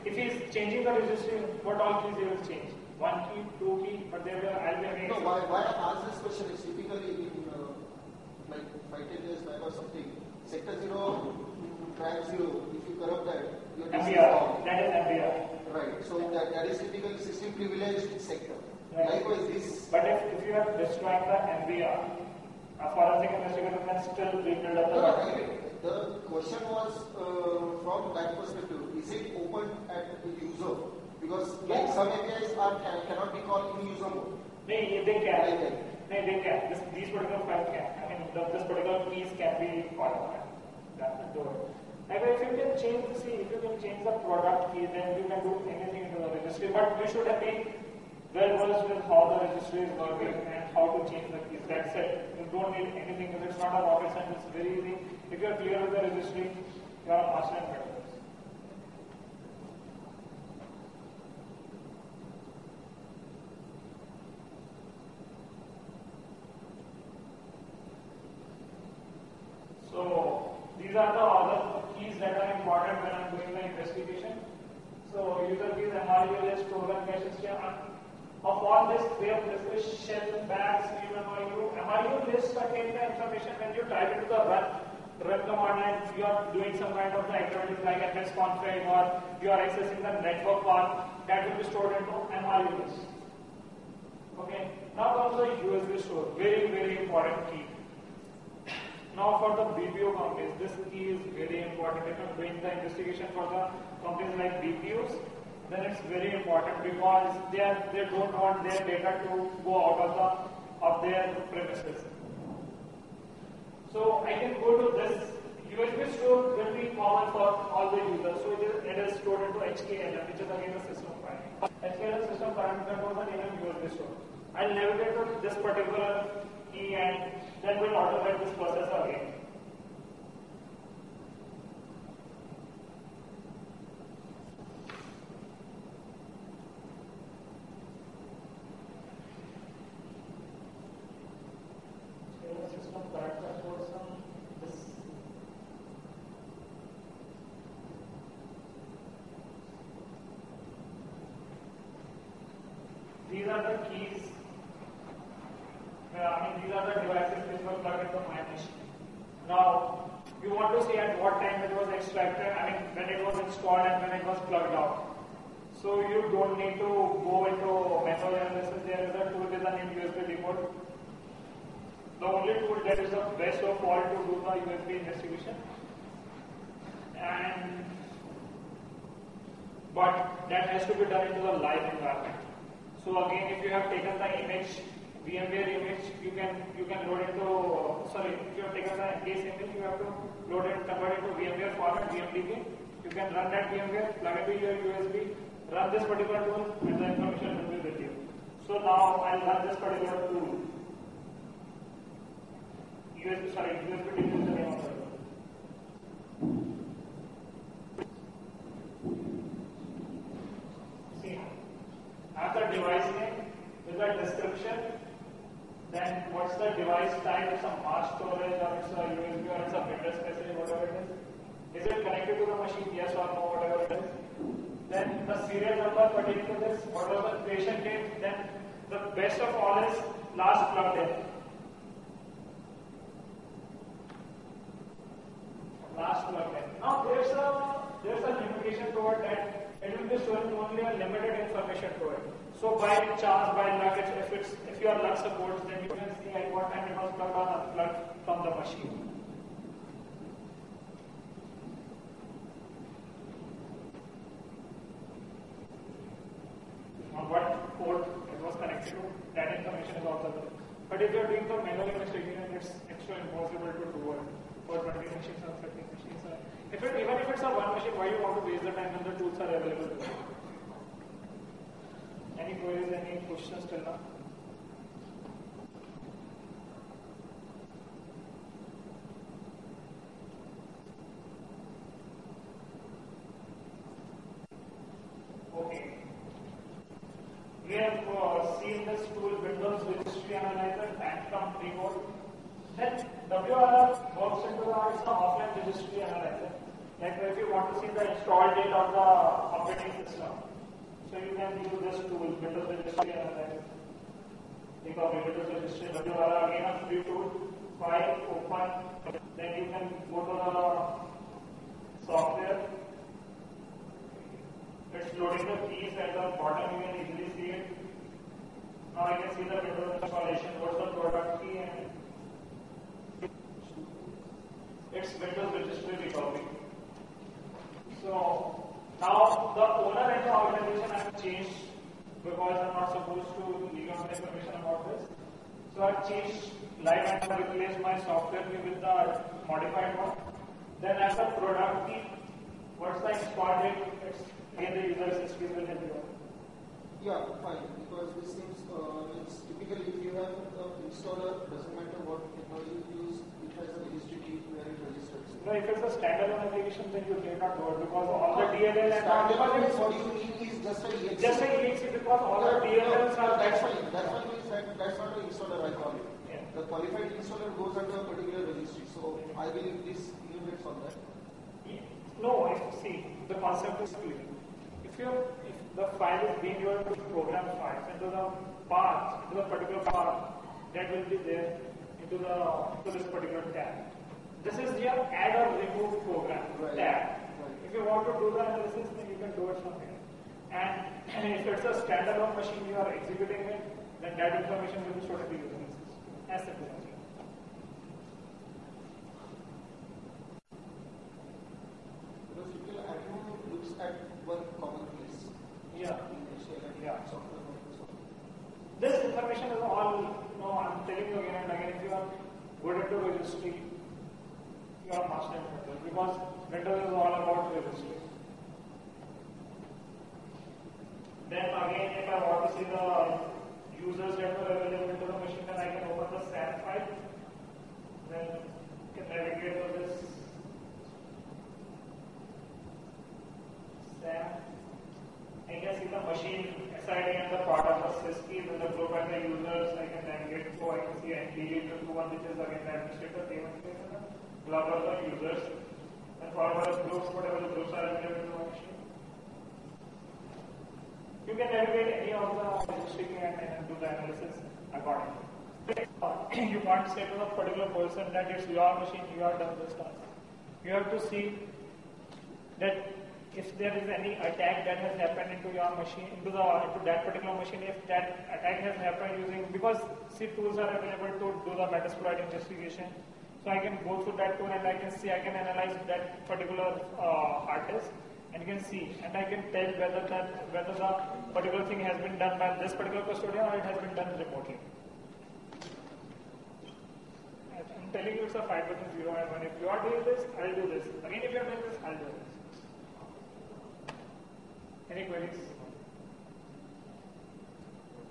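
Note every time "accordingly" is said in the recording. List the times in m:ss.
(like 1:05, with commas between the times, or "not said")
7:34.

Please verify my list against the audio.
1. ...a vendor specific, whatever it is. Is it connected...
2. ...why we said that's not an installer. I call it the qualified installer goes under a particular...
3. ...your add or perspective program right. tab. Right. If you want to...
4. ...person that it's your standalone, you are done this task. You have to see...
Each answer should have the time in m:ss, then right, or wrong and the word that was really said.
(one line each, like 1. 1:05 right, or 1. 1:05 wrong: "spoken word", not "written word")
1. 3:39 right
2. 6:04 right
3. 6:24 wrong: "remove", not "perspective"
4. 7:37 wrong: "machine", not "standalone".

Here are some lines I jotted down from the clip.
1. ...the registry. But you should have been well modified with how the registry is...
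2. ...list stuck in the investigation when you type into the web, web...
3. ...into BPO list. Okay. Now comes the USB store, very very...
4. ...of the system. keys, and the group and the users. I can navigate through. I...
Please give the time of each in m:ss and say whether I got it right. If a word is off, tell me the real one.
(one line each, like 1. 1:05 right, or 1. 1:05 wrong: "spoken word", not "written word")
1. 0:46 wrong: "versed", not "modified"
2. 1:22 wrong: "information", not "investigation"
3. 1:31 wrong: "MRU", not "BPO"
4. 7:17 right.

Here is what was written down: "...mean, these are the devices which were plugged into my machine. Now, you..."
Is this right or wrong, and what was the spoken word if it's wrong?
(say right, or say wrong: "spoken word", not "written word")
right.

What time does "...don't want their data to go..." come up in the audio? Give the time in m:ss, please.
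1:48.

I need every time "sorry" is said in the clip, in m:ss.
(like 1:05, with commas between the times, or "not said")
3:08, 3:23.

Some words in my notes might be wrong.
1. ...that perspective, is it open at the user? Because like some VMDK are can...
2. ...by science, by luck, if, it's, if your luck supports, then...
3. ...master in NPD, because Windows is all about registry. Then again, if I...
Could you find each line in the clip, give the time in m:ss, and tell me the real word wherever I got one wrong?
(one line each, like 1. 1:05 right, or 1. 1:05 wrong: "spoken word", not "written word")
1. 0:28 wrong: "APIs", not "VMDK"
2. 4:02 wrong: "chance", not "science"
3. 6:55 wrong: "Windows", not "NPD".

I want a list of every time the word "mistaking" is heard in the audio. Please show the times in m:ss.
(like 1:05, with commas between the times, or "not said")
4:21.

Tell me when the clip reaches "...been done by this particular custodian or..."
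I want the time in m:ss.
8:02.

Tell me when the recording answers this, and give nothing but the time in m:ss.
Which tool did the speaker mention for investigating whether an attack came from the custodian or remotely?
7:51.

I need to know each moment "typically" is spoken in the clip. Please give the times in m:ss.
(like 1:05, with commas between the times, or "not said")
0:06, 0:16, 5:49.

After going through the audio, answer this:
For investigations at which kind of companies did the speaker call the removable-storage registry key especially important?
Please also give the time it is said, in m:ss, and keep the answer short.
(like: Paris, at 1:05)
BPOs, at 1:44.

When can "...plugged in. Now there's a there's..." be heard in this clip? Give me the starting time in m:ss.
3:56.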